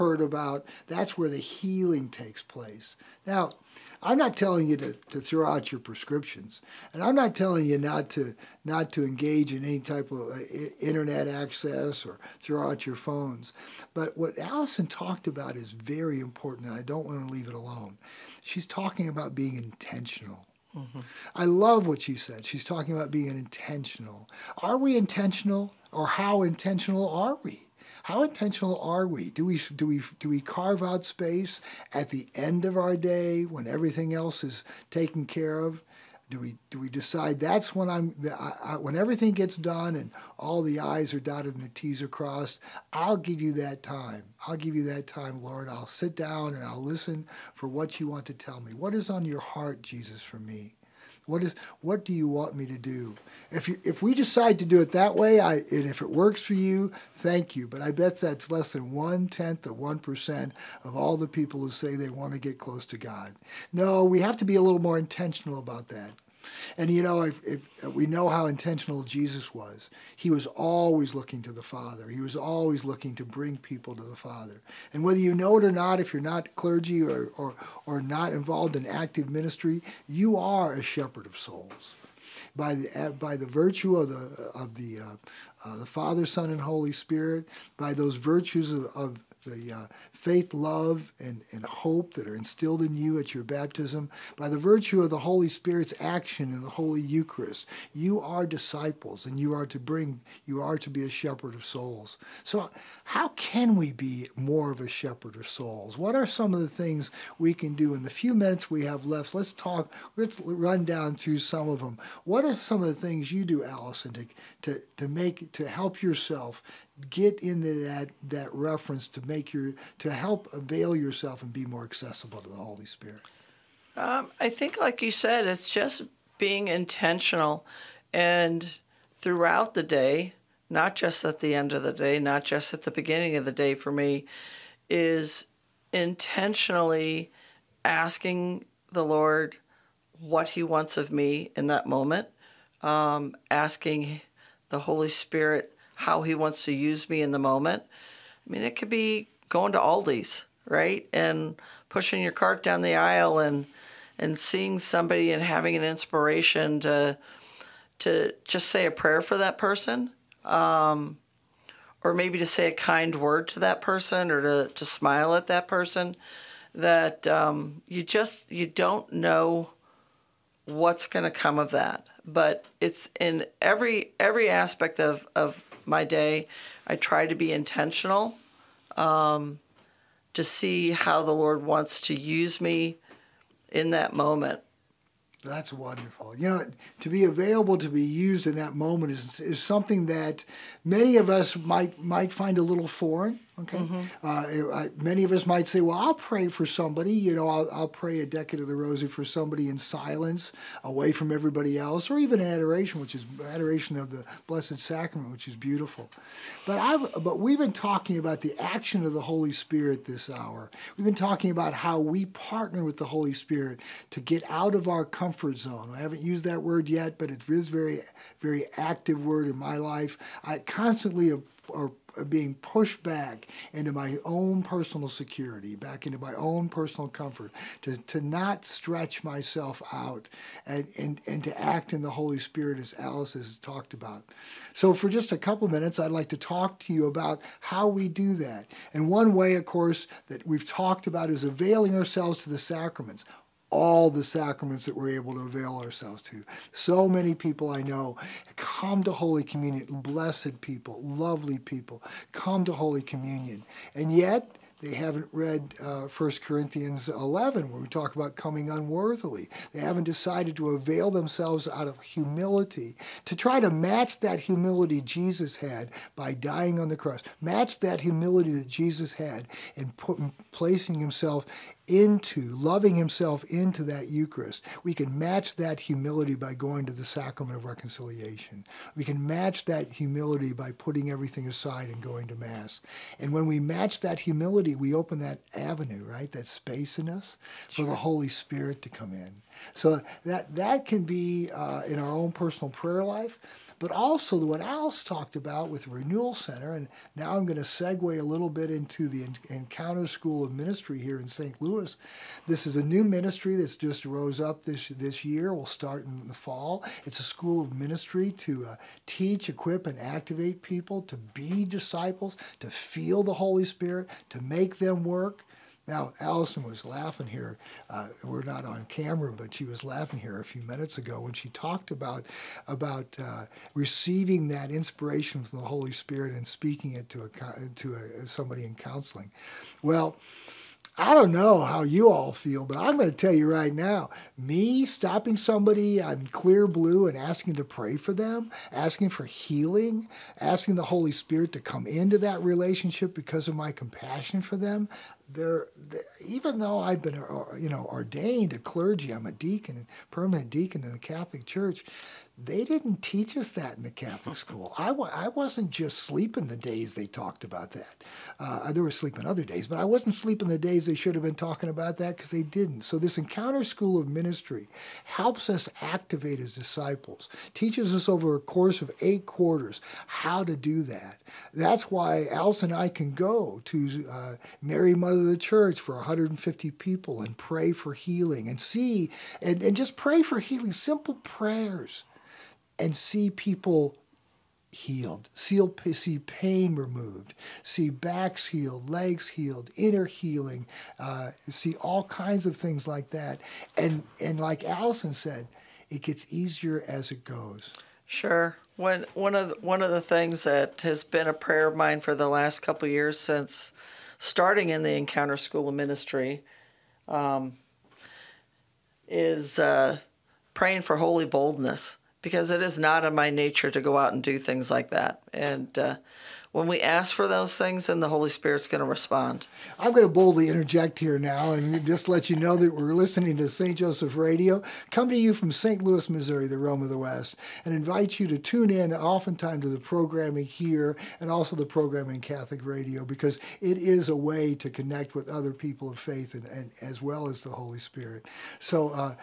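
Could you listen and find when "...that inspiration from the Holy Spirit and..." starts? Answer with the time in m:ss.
5:24.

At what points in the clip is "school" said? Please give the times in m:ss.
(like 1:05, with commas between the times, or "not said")
5:00, 5:07, 5:54, 6:03, 6:45.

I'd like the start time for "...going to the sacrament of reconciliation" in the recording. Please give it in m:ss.
4:36.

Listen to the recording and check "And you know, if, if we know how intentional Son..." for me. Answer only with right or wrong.
wrong.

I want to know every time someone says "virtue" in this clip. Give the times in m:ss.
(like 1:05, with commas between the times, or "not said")
1:23, 1:28, 1:34.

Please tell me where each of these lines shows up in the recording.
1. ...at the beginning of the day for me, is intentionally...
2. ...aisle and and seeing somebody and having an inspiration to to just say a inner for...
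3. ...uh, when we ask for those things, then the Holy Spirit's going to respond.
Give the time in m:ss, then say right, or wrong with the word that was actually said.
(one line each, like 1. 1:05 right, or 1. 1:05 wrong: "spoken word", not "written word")
1. 2:12 right
2. 2:32 wrong: "prayer", not "inner"
3. 6:55 right.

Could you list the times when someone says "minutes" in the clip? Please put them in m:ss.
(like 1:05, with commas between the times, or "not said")
1:48, 3:55, 5:20.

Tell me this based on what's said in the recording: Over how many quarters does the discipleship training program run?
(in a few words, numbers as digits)
8.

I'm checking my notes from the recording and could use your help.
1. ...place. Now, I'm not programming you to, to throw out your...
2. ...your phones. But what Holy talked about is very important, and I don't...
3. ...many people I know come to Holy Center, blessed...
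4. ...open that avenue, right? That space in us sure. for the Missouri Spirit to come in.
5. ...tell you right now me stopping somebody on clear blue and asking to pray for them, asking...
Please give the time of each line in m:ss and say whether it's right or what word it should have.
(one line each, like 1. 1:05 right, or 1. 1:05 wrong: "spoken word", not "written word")
1. 0:02 wrong: "telling", not "programming"
2. 0:12 wrong: "Alison", not "Holy"
3. 4:07 wrong: "Communion", not "Center"
4. 4:44 wrong: "Holy", not "Missouri"
5. 5:33 right.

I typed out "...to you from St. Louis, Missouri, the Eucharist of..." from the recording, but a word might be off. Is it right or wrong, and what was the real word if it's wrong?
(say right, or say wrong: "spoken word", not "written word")
wrong: "Rome", not "Eucharist".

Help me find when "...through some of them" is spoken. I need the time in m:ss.
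1:51.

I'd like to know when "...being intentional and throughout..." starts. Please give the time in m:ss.
2:06.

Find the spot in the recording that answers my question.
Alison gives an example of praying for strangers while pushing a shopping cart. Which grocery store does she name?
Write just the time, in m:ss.
2:29.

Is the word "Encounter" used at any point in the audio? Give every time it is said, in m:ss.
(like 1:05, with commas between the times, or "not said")
4:59, 6:03, 6:44.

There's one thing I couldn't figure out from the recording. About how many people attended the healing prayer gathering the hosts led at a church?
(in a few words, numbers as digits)
150.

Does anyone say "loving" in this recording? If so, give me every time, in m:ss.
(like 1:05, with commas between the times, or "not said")
4:32.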